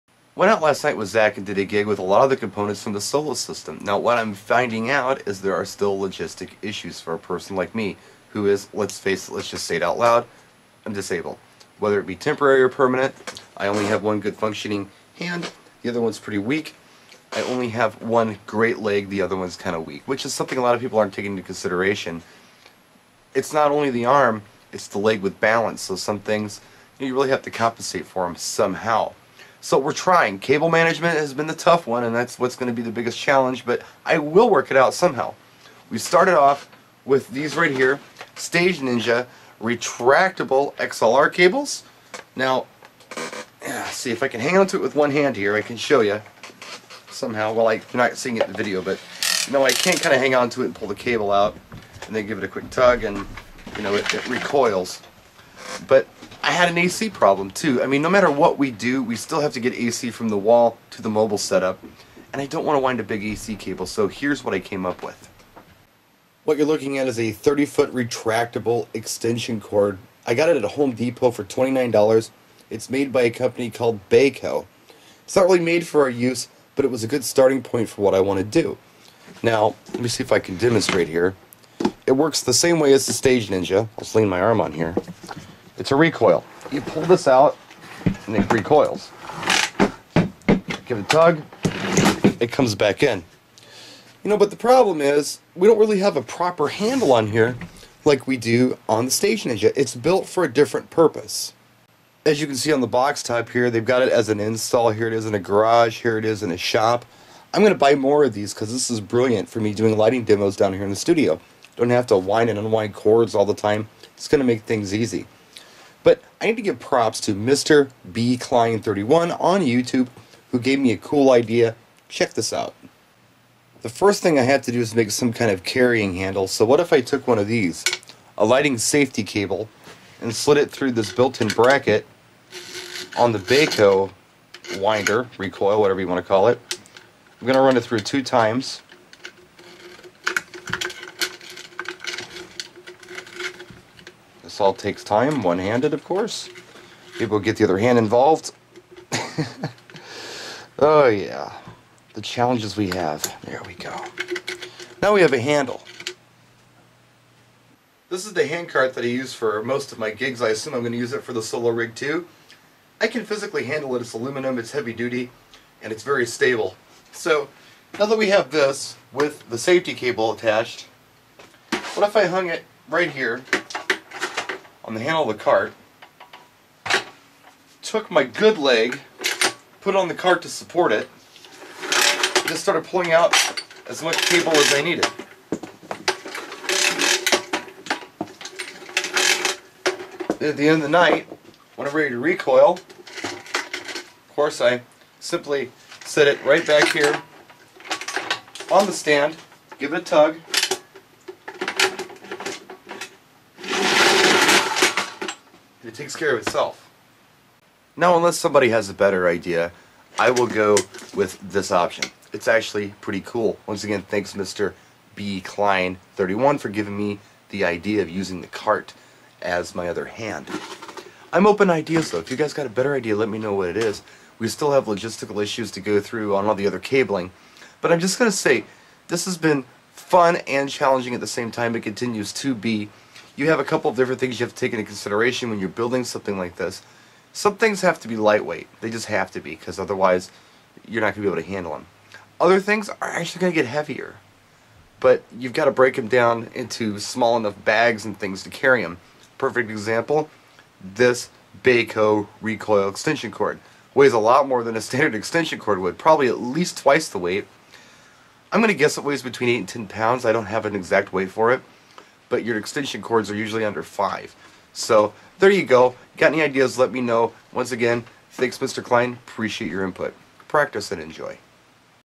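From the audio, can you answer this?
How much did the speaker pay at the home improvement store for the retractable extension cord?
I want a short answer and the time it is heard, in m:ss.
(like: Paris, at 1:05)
$29, at 1:11.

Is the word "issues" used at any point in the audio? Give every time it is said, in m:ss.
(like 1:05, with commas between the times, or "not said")
0:06, 3:45.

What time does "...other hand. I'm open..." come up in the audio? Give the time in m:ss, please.
3:39.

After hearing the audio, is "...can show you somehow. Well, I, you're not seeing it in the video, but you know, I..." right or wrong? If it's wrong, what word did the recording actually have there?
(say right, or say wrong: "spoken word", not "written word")
right.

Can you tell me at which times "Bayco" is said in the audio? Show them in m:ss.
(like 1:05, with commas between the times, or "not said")
1:14, 2:13, 4:11.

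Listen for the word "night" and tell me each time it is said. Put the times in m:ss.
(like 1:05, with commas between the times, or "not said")
0:00, 3:10.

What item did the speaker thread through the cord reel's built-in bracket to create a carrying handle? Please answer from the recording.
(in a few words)
lighting safety cable.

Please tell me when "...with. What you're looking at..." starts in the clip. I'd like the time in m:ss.
1:05.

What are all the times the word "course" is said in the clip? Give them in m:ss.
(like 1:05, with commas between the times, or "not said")
2:26, 3:14.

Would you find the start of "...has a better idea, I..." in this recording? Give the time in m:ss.
3:28.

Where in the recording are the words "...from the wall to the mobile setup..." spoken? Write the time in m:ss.
1:00.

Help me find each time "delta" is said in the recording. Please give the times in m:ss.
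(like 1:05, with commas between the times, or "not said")
not said.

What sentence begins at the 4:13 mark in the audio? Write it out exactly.
Weighs a lot more than a standard extension cord would, probably at least twice the weight.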